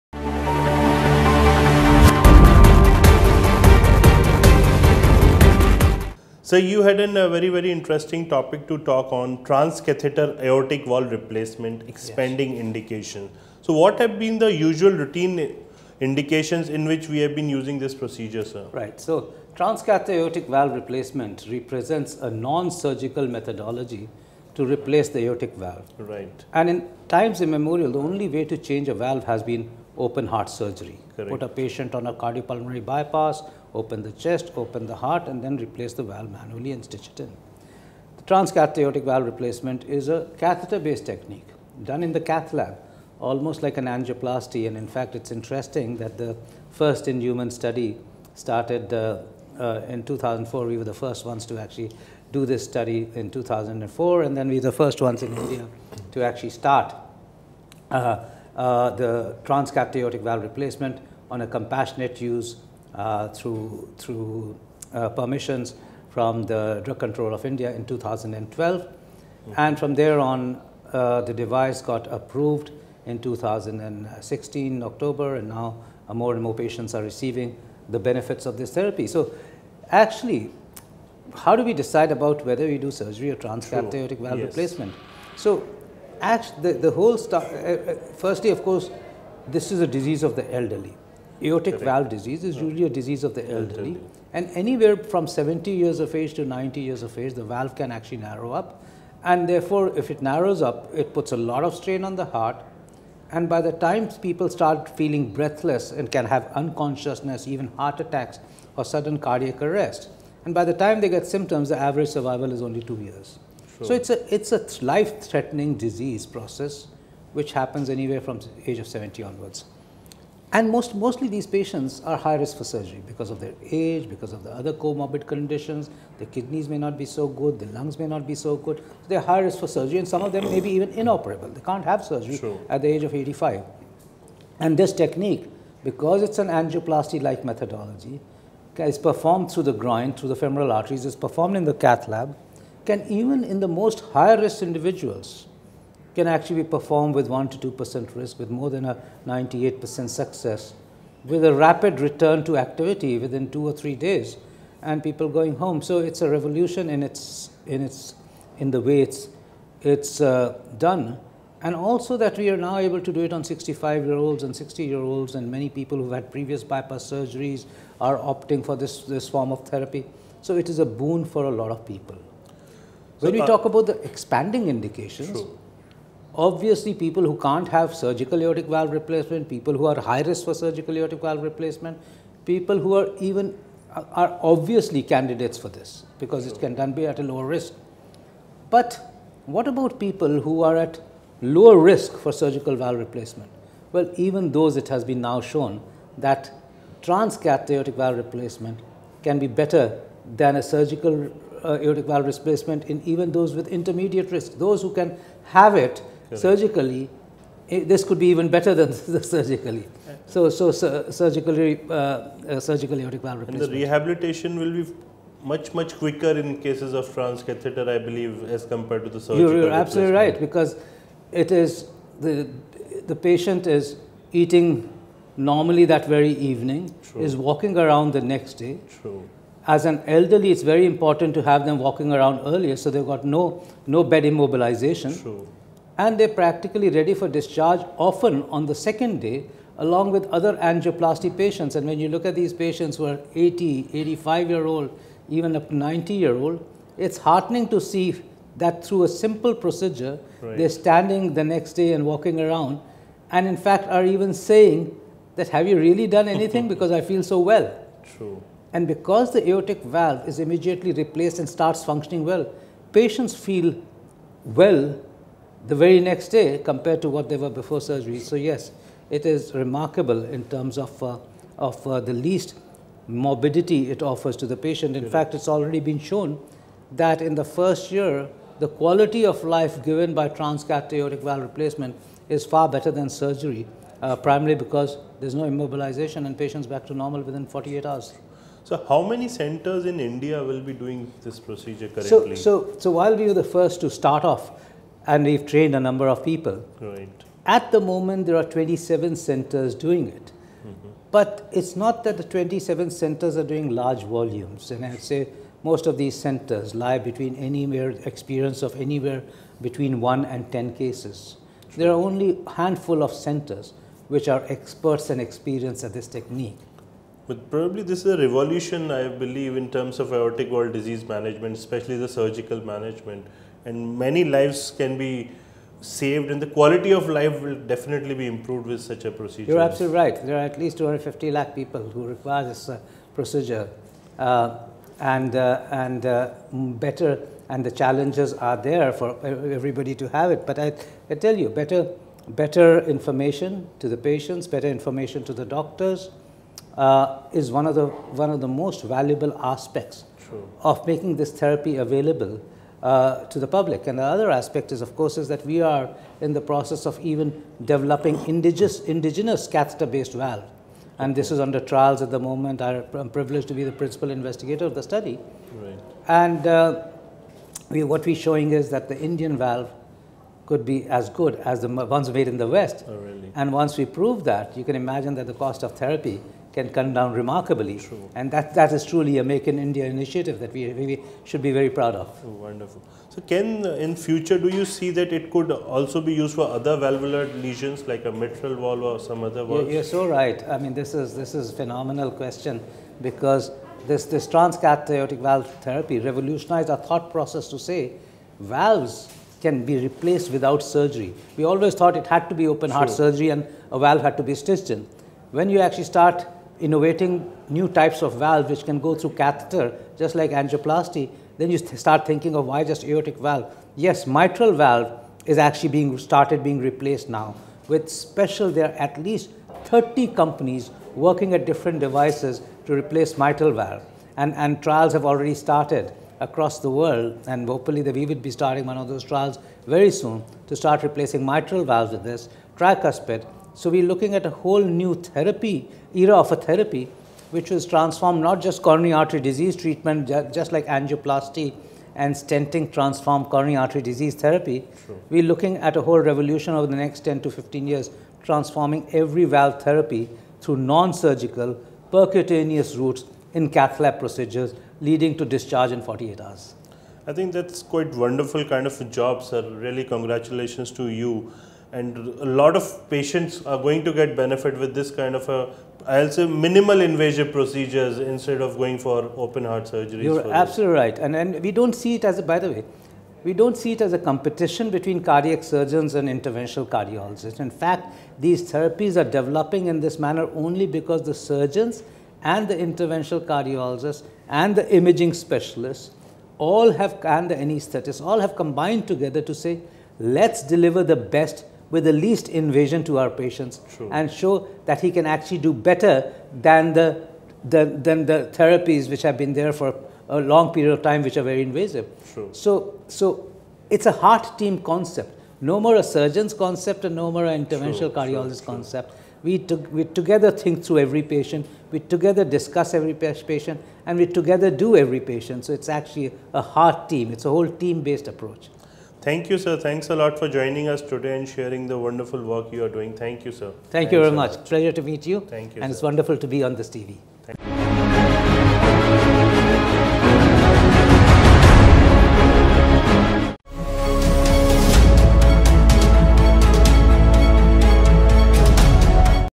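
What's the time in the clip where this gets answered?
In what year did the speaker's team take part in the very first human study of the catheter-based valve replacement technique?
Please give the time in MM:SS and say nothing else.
00:48.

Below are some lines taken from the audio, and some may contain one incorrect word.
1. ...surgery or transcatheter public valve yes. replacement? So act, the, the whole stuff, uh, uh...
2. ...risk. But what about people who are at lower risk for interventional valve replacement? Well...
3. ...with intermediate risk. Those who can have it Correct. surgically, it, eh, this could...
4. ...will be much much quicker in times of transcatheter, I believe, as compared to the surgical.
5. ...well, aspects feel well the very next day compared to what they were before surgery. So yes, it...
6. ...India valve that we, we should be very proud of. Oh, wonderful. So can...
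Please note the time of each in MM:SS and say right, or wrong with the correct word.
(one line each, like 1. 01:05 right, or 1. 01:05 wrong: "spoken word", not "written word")
1. 01:22 wrong: "aortic", not "public"
2. 03:07 wrong: "surgical", not "interventional"
3. 03:23 right
4. 03:34 wrong: "cases", not "times"
5. 04:22 wrong: "patients", not "aspects"
6. 06:19 wrong: "initiative", not "valve".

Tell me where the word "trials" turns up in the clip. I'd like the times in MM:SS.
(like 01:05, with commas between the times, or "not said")
06:01, 07:04, 07:09.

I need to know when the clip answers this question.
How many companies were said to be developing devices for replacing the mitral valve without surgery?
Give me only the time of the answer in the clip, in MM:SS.
06:58.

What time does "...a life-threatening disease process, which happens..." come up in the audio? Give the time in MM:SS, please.
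01:54.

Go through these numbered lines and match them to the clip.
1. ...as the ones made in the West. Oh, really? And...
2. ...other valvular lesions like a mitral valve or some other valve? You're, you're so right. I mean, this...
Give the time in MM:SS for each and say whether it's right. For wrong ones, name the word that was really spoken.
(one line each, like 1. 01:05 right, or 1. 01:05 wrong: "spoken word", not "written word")
1. 06:11 right
2. 06:26 right.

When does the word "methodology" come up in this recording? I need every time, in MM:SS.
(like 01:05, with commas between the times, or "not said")
00:23, 02:17.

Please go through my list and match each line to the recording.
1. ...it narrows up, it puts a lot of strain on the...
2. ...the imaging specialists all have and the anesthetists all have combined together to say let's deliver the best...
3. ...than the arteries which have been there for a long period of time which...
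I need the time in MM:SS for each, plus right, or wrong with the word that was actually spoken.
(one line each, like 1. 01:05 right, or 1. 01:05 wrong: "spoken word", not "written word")
1. 01:40 right
2. 08:04 right
3. 08:17 wrong: "therapies", not "arteries".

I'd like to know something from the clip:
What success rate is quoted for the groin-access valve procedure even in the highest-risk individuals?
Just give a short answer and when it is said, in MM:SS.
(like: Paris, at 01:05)
more than 98%, at 02:28.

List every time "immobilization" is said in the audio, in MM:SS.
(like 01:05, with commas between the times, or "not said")
03:54, 04:45.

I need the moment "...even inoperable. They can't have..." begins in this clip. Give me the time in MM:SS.
02:10.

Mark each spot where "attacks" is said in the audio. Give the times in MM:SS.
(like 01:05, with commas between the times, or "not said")
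01:47.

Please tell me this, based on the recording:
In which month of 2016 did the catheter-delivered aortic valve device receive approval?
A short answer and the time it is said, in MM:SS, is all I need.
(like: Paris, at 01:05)
October, at 01:13.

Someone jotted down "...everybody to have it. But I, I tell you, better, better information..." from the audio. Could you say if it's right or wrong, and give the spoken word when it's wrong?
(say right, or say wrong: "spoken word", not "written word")
right.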